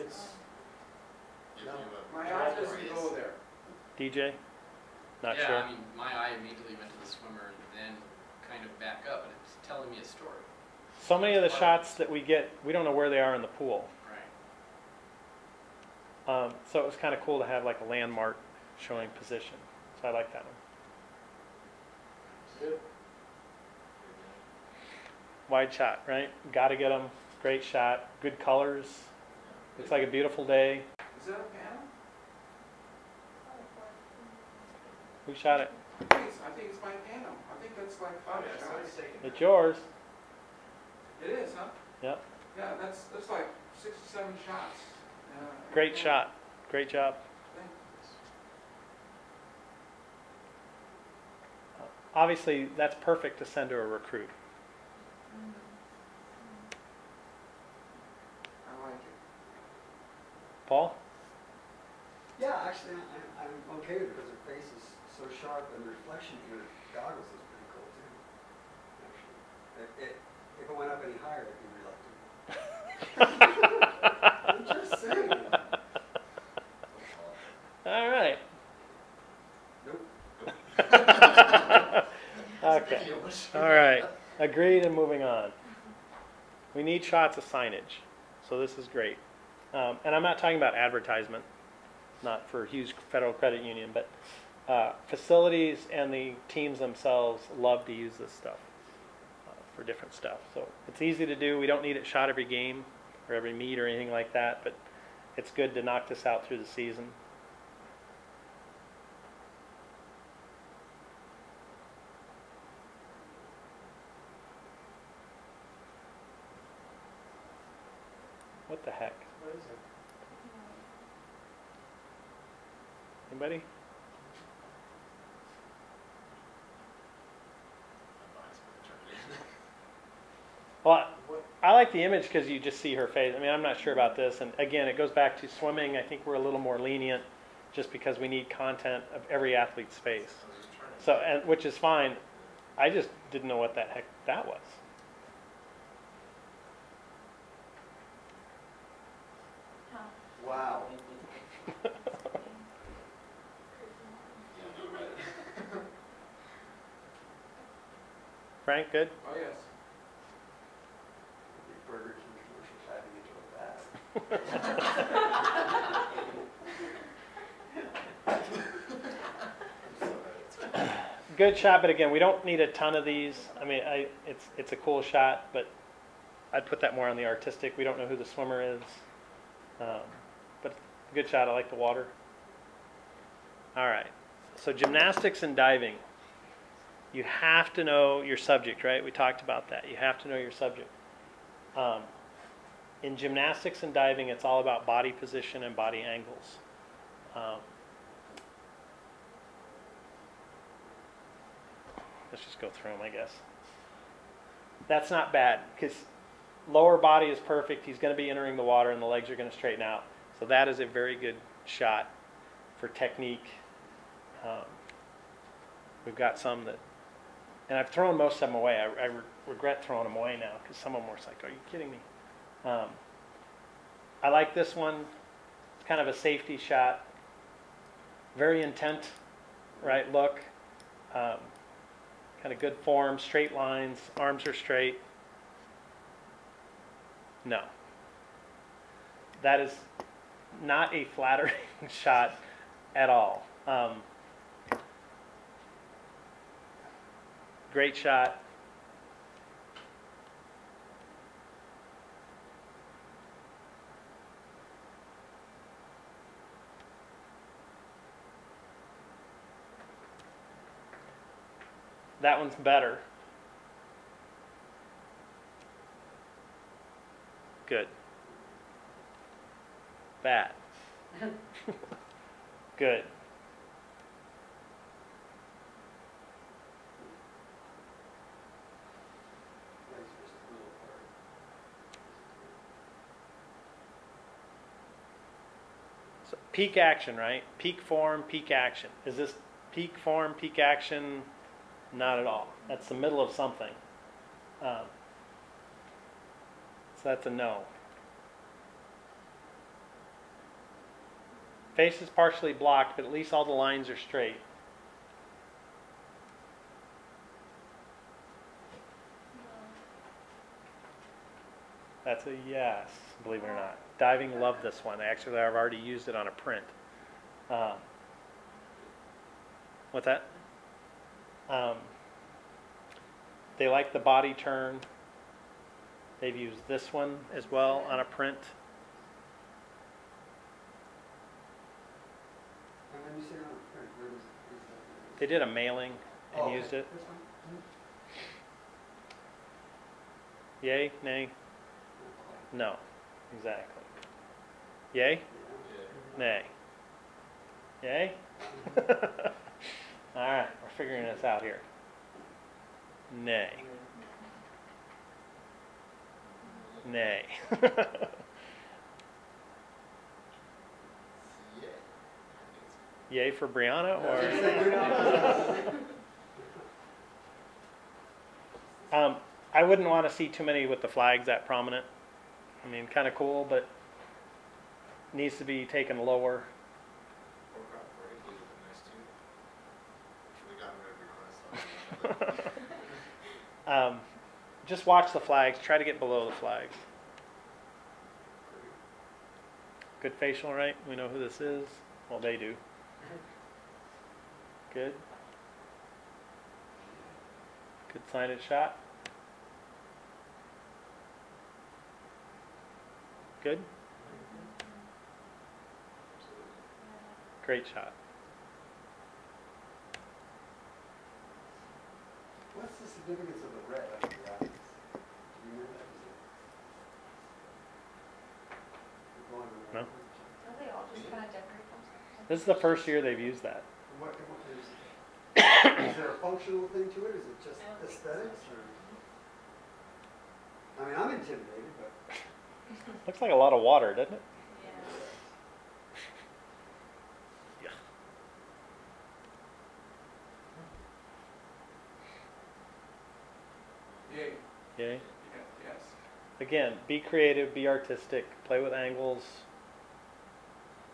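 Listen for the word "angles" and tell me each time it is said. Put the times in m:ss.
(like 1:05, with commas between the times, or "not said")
3:16, 7:28.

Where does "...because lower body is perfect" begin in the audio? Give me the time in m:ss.
3:25.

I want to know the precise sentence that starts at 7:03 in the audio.
What, what is, is there a functional thing to it?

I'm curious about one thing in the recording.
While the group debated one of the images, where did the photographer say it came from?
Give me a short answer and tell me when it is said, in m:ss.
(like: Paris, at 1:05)
my panel, at 0:36.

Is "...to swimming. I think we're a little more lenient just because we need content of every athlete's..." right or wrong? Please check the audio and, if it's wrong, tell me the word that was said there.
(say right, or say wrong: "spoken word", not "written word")
right.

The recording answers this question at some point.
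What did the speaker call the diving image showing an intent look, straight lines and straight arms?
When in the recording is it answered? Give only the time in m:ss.
3:46.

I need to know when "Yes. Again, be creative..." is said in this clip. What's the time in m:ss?
7:25.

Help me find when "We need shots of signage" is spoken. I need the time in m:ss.
1:26.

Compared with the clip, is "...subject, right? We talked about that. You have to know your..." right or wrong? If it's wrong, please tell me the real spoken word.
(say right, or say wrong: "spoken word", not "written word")
right.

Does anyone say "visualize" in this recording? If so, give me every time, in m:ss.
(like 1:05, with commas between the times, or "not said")
not said.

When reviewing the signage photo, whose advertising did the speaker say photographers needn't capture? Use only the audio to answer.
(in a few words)
Hughes Federal Credit Union.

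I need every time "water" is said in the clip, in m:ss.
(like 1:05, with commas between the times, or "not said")
3:01, 3:28, 7:13.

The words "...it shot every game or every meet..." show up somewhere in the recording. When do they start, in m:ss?
1:41.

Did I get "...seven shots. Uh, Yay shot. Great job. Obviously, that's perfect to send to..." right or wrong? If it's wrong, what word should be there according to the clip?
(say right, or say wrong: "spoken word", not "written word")
wrong: "Great", not "Yay".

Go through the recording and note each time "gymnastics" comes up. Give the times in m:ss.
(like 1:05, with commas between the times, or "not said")
3:04, 3:13.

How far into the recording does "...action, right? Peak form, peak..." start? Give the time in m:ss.
4:46.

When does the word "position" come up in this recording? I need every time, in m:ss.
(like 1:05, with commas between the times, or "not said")
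0:19, 3:15.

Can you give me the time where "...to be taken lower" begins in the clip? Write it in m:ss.
6:15.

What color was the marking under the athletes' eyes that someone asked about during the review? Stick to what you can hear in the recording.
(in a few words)
red.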